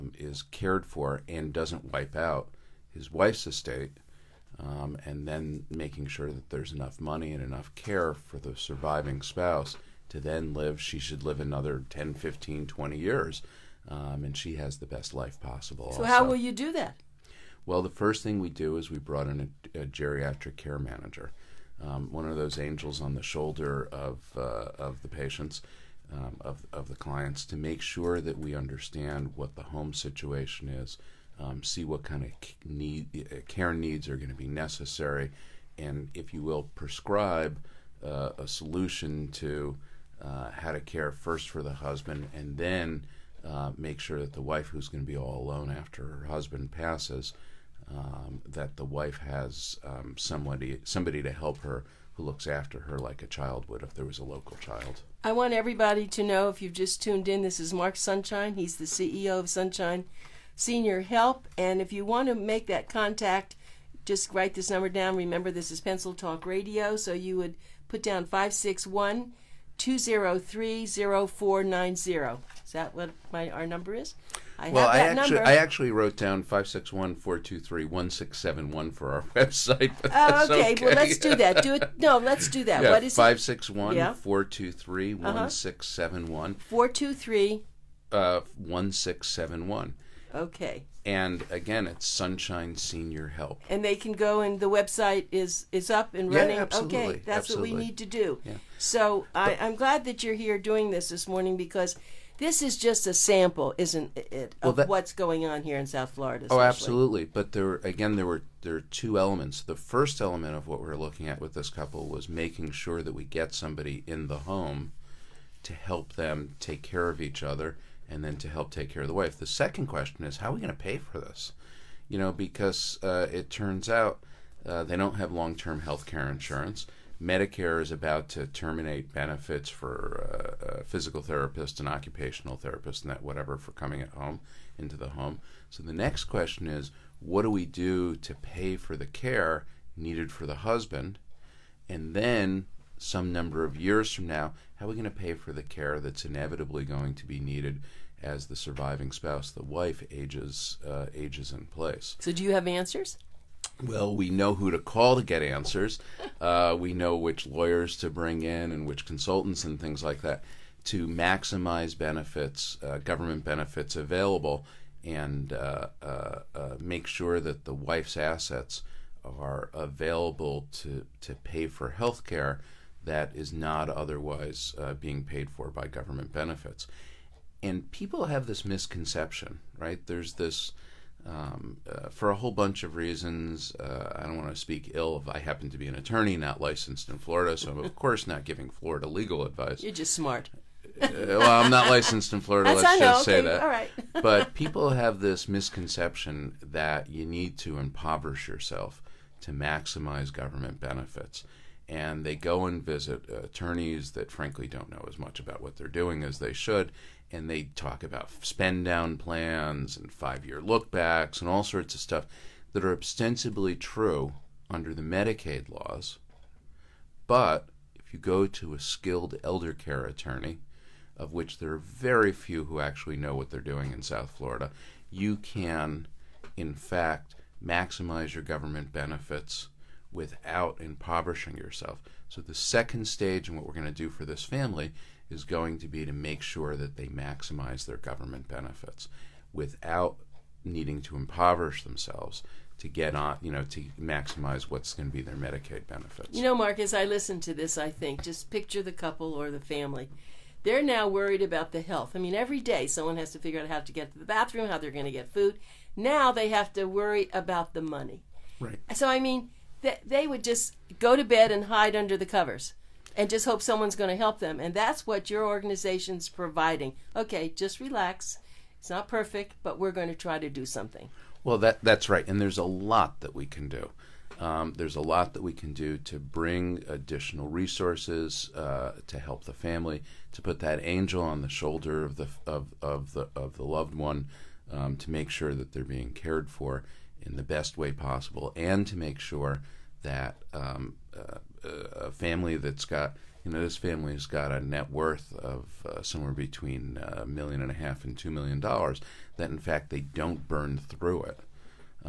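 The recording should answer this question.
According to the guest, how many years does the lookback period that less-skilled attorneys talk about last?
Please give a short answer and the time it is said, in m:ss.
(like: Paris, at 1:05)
5 years, at 3:30.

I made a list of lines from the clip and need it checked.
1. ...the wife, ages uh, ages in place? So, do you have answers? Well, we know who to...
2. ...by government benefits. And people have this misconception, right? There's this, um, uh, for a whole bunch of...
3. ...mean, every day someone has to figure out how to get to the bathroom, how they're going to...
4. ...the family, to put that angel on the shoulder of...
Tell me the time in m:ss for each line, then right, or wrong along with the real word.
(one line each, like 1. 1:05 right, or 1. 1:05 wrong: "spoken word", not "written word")
1. 2:29 right
2. 2:55 right
3. 4:12 right
4. 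4:39 right.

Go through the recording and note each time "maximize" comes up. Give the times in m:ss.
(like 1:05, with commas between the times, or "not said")
2:41, 3:19, 3:47, 3:57, 4:03.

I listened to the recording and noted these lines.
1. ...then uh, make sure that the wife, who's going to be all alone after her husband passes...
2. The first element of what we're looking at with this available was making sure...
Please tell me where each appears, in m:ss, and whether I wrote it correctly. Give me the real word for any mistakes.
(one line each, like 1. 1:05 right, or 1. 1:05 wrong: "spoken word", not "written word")
1. 0:42 right
2. 1:49 wrong: "couple", not "available".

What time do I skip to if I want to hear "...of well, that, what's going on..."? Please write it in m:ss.
1:44.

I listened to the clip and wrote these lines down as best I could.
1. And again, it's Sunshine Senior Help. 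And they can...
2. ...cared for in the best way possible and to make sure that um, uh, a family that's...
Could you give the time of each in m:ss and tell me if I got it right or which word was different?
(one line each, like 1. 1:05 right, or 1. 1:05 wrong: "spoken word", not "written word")
1. 1:31 right
2. 4:46 right.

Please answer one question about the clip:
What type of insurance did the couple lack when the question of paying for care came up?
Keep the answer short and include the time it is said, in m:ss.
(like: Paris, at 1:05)
long term health care insurance, at 2:05.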